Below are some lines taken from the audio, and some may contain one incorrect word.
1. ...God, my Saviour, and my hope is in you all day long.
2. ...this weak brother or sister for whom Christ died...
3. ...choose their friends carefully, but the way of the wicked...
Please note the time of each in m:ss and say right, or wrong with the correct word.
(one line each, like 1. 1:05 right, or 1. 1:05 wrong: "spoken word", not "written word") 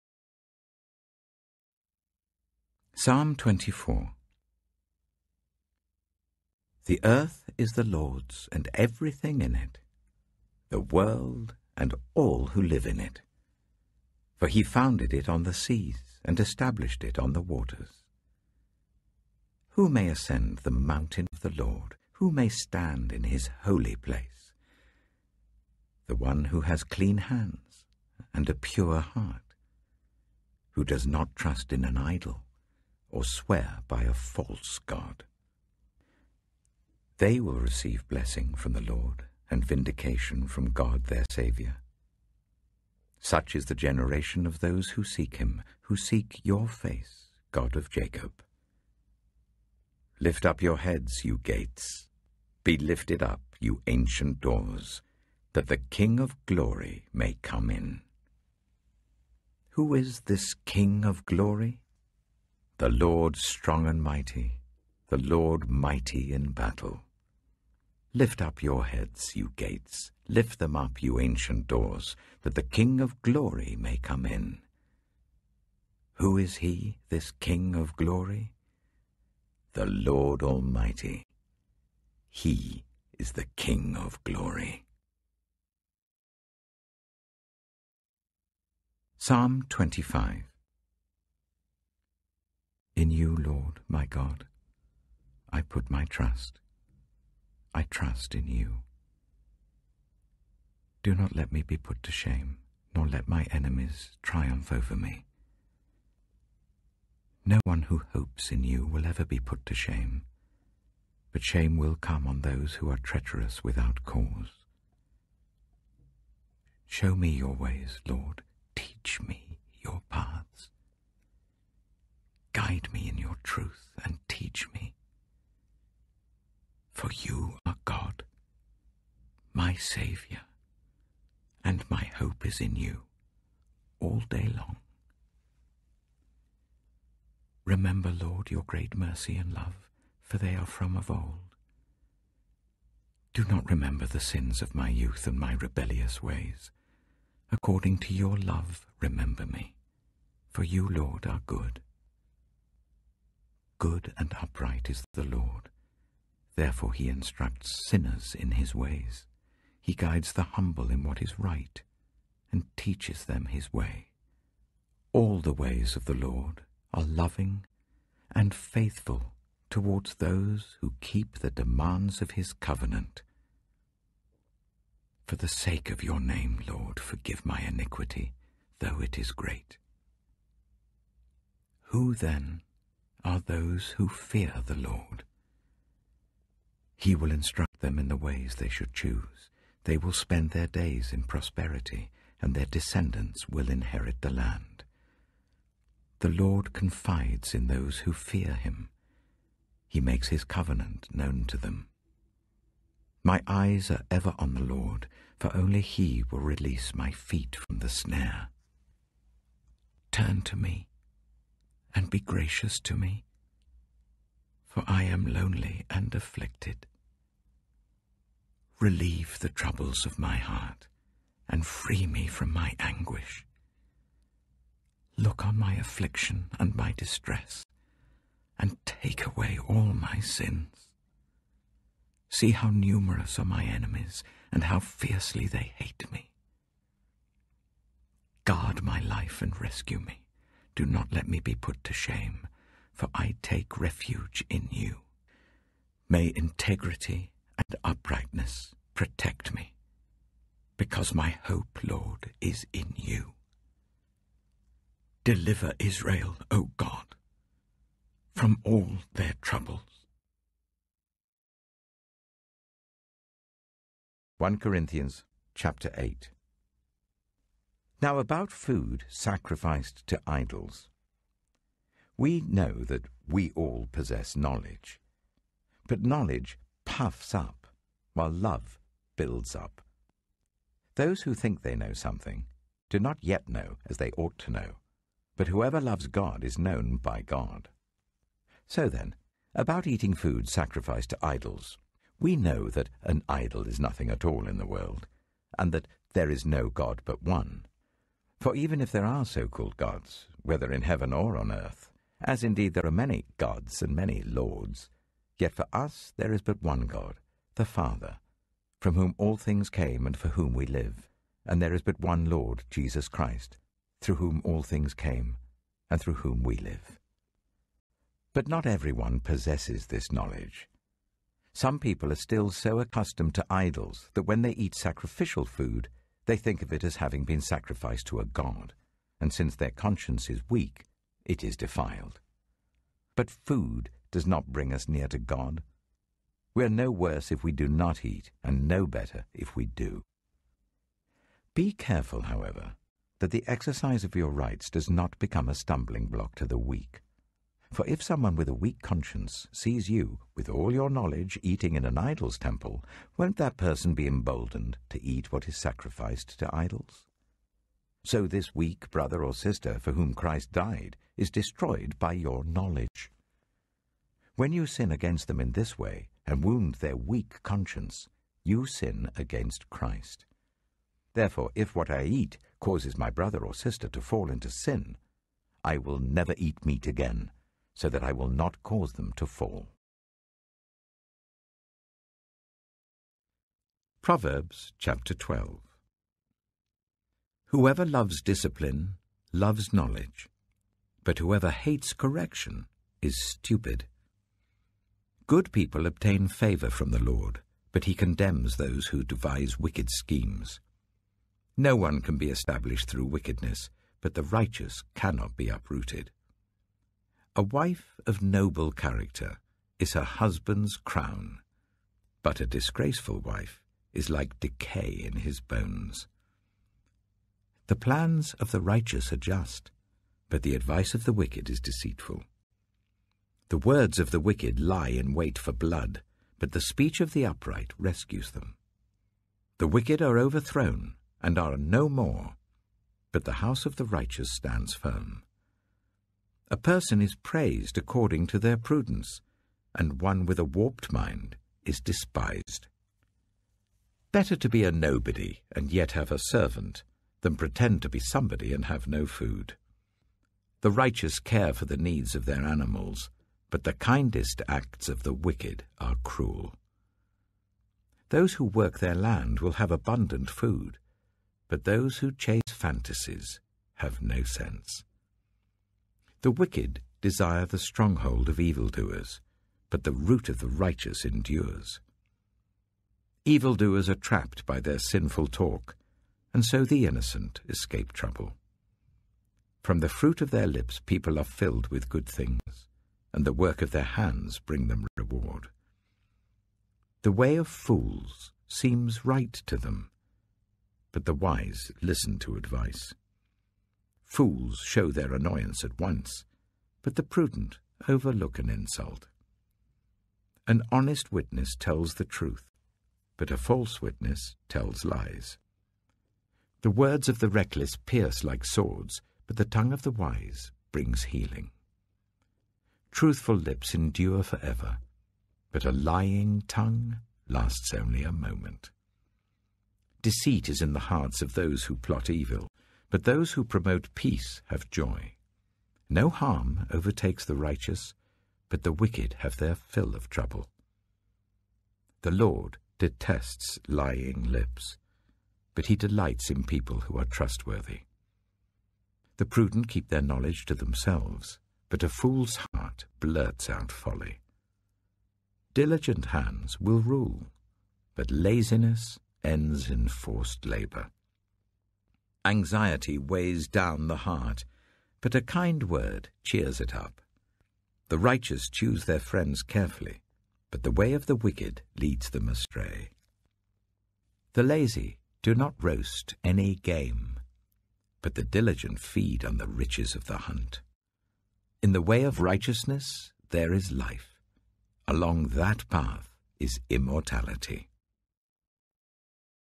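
1. 2:07 right
2. 5:58 right
3. 9:18 right.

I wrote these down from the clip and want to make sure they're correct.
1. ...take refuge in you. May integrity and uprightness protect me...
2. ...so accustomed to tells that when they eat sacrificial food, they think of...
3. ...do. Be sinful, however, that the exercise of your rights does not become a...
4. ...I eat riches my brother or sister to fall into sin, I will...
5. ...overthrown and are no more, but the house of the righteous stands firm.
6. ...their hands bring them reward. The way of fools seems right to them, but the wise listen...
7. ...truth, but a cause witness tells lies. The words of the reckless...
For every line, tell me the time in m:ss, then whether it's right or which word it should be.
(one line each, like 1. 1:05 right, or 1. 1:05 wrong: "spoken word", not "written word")
1. 4:03 right
2. 5:22 wrong: "idols", not "tells"
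3. 5:39 wrong: "careful", not "sinful"
4. 6:11 wrong: "causes", not "riches"
5. 7:10 right
6. 8:03 right
7. 8:22 wrong: "false", not "cause".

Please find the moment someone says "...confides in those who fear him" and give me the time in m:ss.
3:16.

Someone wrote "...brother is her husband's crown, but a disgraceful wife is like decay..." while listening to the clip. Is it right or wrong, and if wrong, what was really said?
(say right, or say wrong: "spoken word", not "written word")
wrong: "character", not "brother".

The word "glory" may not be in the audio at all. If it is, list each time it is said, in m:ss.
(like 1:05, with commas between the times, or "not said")
0:56, 1:01, 1:13, 1:17, 1:24.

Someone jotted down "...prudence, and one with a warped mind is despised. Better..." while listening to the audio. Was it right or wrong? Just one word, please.
right.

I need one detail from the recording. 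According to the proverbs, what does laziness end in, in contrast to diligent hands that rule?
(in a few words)
Forced labour.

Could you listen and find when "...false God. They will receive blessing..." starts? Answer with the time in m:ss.
0:34.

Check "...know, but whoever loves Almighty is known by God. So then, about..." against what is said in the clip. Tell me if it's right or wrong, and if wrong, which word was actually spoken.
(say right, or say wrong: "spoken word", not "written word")
wrong: "God", not "Almighty".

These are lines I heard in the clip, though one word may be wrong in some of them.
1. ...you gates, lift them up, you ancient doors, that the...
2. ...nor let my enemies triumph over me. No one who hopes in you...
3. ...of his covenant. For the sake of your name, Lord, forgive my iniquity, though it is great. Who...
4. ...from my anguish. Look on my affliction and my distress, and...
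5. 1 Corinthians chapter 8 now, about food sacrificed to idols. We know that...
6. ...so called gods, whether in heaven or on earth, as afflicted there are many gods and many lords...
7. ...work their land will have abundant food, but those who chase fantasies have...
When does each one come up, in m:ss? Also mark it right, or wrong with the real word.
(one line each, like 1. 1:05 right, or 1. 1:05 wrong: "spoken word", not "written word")
1. 1:09 right
2. 1:42 right
3. 2:52 right
4. 3:42 right
5. 4:24 right
6. 4:59 wrong: "indeed", not "afflicted"
7. 7:38 right.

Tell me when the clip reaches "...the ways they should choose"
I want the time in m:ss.
3:08.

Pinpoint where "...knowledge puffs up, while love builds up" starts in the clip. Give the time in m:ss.
4:36.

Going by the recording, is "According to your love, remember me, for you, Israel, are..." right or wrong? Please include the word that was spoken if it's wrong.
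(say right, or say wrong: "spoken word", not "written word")
wrong: "Lord", not "Israel".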